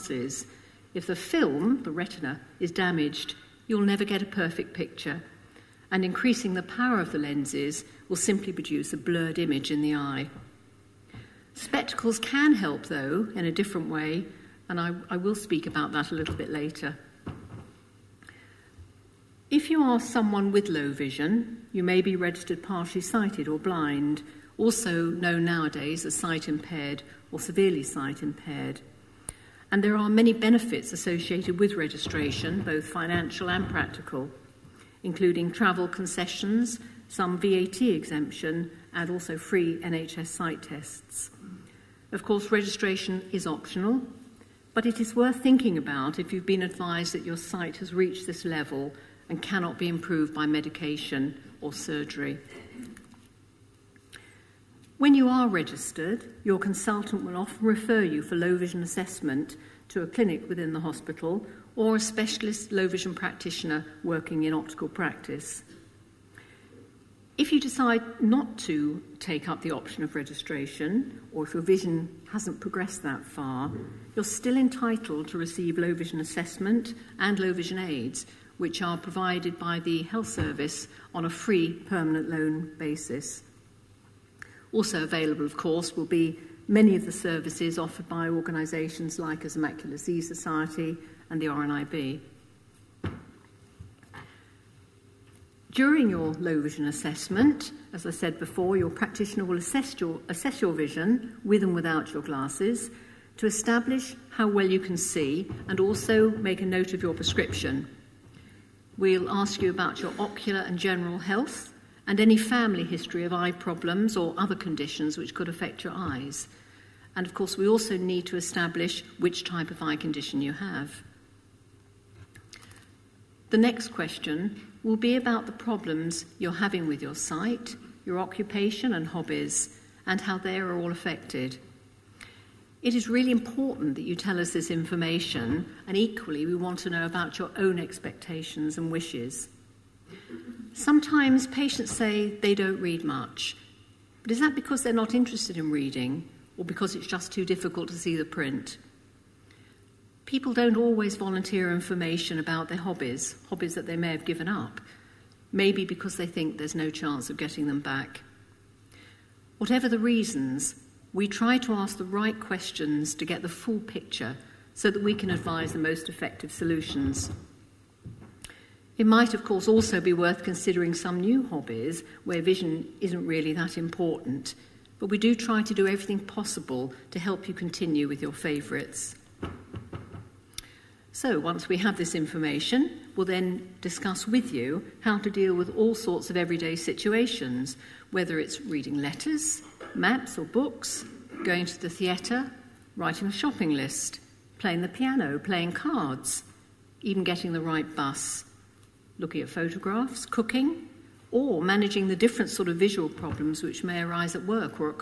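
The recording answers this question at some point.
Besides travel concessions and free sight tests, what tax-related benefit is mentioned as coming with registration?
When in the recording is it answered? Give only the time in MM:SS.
00:37.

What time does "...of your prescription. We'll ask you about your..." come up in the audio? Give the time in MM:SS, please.
01:46.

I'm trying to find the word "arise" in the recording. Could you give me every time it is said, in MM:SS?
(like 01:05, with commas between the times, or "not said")
03:24.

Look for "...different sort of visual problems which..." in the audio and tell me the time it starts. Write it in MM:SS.
03:22.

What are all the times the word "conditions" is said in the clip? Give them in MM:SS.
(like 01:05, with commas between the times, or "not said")
01:54, 01:59.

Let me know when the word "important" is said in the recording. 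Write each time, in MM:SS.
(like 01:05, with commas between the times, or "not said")
02:13, 02:53.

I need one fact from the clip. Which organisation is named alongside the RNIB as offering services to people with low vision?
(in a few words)
Macular Disease Society.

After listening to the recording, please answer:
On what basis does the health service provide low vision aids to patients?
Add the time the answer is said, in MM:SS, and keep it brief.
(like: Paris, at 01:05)
Free permanent loan, at 01:21.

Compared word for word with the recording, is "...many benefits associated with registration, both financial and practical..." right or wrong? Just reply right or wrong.
right.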